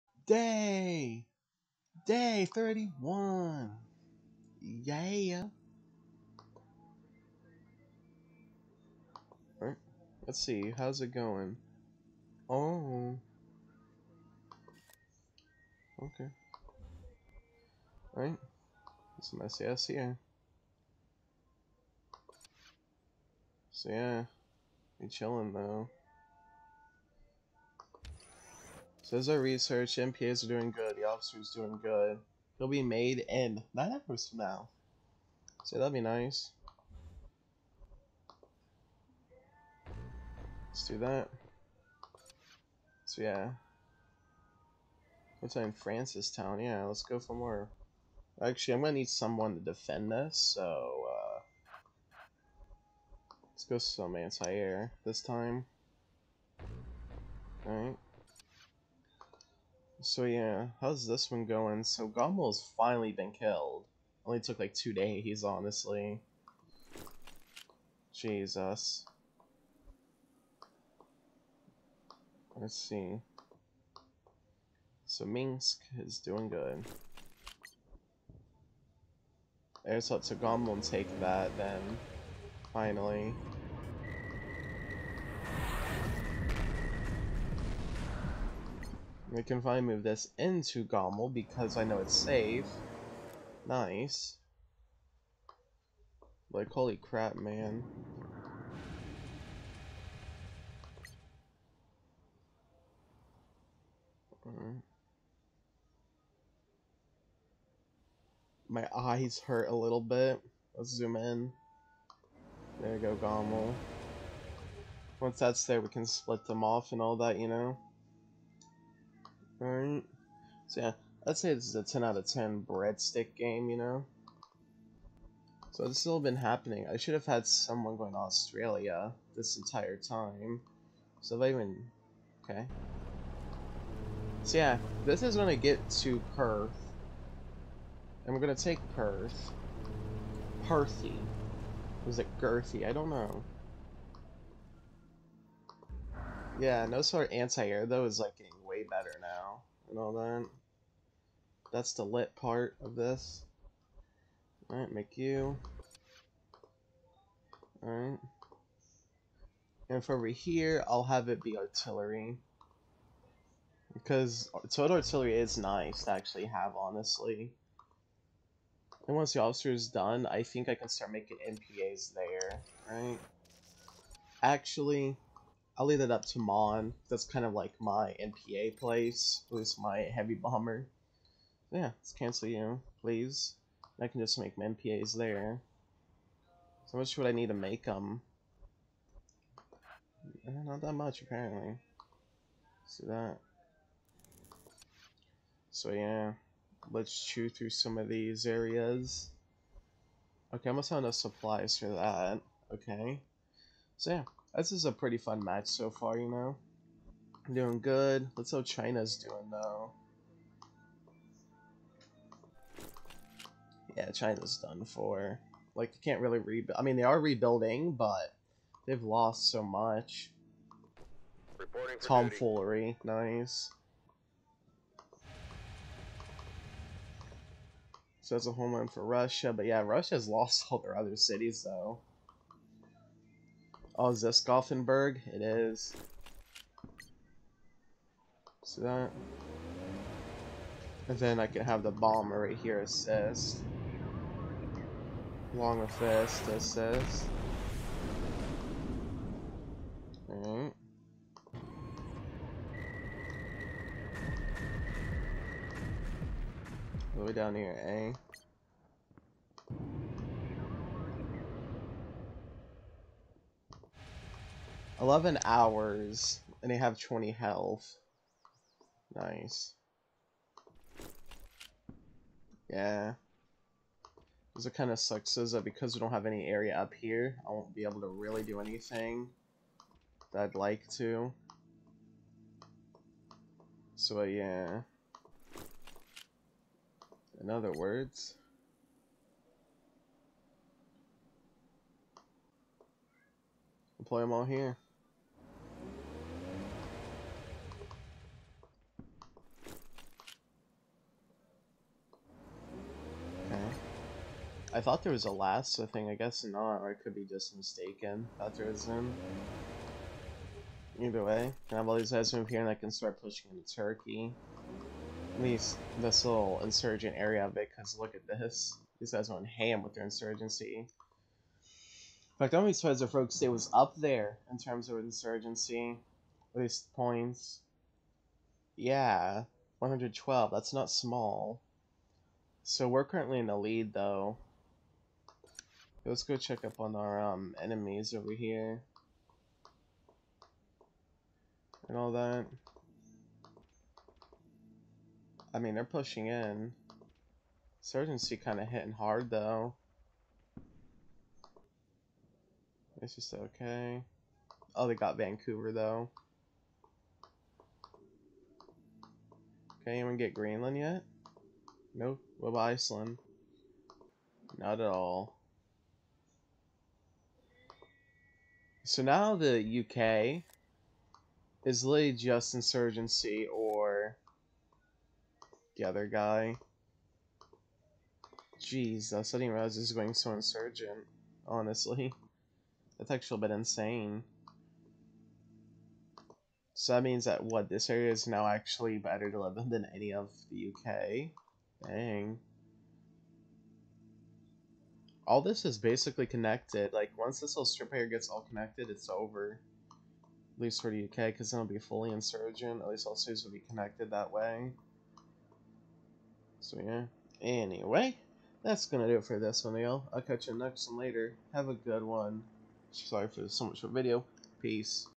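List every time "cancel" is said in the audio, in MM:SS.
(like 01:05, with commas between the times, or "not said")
03:02.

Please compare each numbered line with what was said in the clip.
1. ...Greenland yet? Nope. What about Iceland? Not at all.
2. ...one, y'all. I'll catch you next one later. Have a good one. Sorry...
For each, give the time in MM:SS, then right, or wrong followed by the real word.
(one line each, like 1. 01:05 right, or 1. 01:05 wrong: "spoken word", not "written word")
1. 06:00 right
2. 06:49 right.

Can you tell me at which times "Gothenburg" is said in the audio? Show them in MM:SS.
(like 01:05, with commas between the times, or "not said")
03:54.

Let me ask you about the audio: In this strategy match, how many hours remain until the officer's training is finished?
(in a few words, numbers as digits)
9.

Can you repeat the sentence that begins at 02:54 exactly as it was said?
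Actually, I'll leave that up to Mon.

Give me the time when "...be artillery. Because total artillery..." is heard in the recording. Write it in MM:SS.
02:41.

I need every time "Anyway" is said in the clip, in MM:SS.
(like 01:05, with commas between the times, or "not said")
06:47.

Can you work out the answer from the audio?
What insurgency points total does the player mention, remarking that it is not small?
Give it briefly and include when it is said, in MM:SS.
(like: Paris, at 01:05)
112, at 05:29.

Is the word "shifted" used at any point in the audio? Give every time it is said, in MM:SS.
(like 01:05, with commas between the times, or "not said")
not said.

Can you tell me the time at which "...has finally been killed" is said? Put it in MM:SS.
01:02.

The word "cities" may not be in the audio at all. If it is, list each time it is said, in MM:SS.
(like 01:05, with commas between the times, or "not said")
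03:51, 06:43.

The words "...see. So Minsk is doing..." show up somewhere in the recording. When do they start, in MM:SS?
01:12.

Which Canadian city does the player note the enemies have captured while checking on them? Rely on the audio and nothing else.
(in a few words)
Vancouver.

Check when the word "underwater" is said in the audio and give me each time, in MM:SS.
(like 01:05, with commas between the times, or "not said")
not said.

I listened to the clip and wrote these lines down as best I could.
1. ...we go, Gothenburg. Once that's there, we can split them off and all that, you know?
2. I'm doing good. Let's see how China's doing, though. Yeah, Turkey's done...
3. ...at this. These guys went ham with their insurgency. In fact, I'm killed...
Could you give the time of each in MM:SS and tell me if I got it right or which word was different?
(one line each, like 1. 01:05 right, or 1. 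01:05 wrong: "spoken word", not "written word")
1. 01:52 wrong: "Gomel", not "Gothenburg"
2. 03:27 wrong: "China", not "Turkey"
3. 05:18 wrong: "surprised", not "killed".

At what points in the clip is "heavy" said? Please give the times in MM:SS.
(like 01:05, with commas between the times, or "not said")
02:59.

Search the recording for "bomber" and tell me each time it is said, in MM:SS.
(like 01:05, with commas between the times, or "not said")
03:00, 04:01.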